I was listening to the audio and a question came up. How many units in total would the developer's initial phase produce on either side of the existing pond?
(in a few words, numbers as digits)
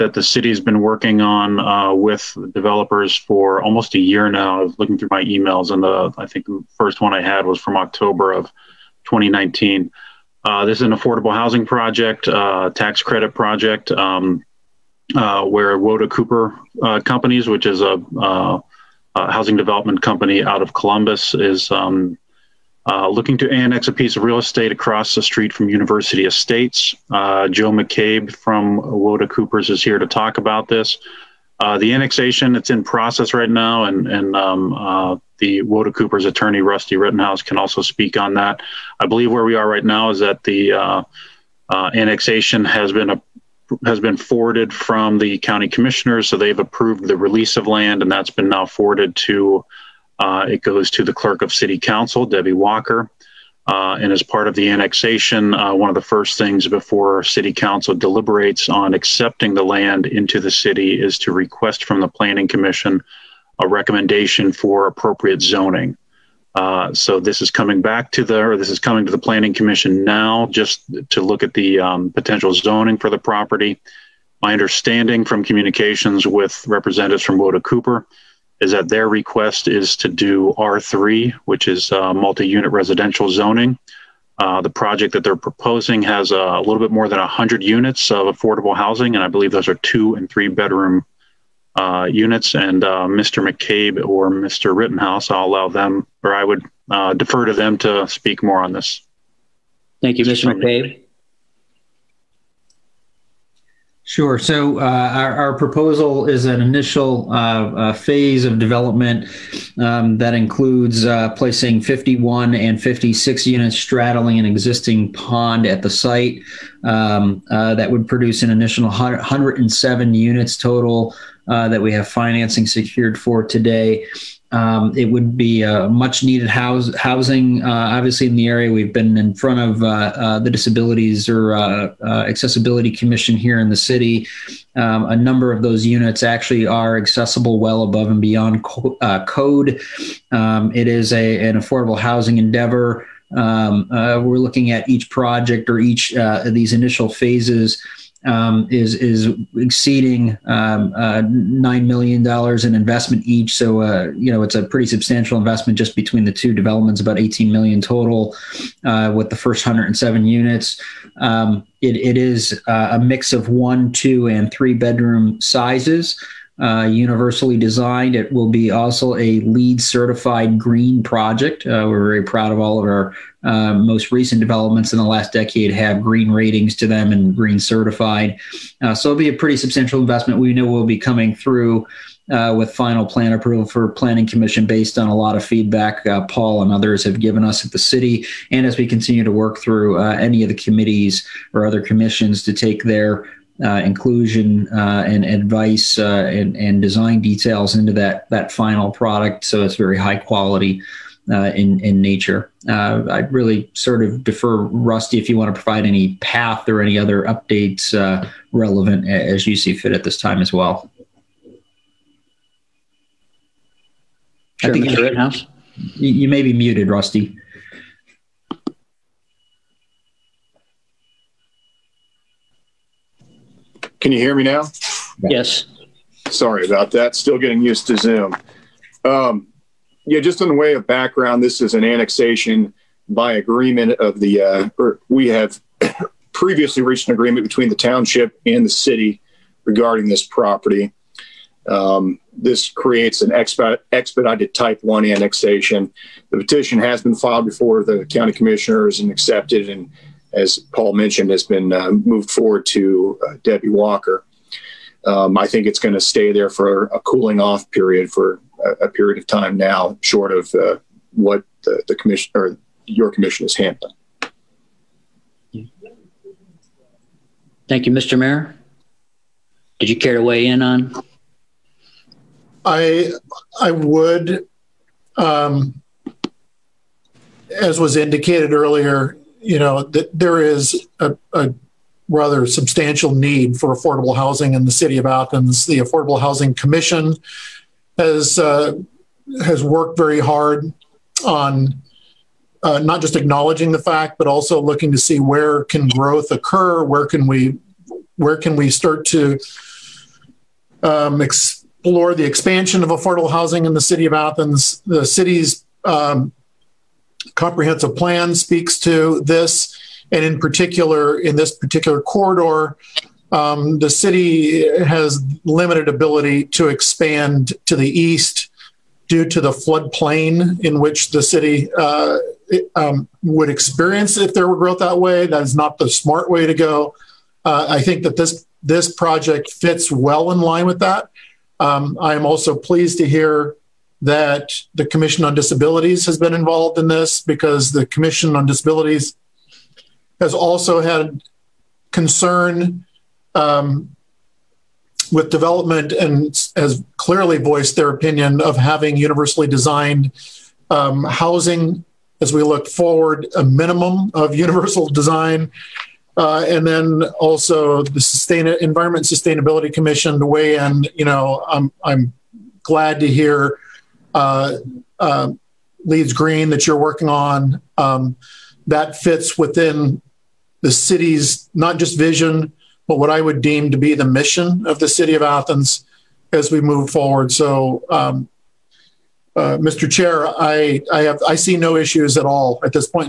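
107.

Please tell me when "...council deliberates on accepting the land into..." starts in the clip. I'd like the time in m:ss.
0:57.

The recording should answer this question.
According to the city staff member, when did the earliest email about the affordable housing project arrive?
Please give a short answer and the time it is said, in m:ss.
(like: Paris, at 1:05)
October 2019, at 0:07.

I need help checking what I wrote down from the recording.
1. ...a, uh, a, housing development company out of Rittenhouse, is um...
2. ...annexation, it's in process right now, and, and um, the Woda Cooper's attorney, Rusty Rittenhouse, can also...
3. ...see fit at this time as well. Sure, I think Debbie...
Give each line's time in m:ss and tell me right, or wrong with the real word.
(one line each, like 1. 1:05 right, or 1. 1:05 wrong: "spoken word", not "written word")
1. 0:17 wrong: "Columbus", not "Rittenhouse"
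2. 0:31 right
3. 3:29 wrong: "You", not "Debbie".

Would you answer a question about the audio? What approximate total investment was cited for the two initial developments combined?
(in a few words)
about eighteen million.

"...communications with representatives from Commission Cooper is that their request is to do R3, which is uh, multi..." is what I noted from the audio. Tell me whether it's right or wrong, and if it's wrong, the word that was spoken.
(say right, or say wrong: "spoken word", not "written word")
wrong: "Woda", not "Commission".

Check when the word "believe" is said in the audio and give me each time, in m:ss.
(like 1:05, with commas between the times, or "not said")
0:39, 1:29.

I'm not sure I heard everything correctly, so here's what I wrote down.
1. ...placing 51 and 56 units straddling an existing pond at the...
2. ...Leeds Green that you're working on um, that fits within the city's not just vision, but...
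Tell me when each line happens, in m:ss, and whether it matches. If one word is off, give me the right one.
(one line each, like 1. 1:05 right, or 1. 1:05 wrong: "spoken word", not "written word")
1. 1:51 right
2. 6:05 right.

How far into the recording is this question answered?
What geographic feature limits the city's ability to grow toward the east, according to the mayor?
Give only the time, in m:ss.
5:19.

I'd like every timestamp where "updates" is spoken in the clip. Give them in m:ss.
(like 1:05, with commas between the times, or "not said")
3:27.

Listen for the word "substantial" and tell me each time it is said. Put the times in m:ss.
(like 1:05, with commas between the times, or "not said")
2:34, 2:59, 4:42.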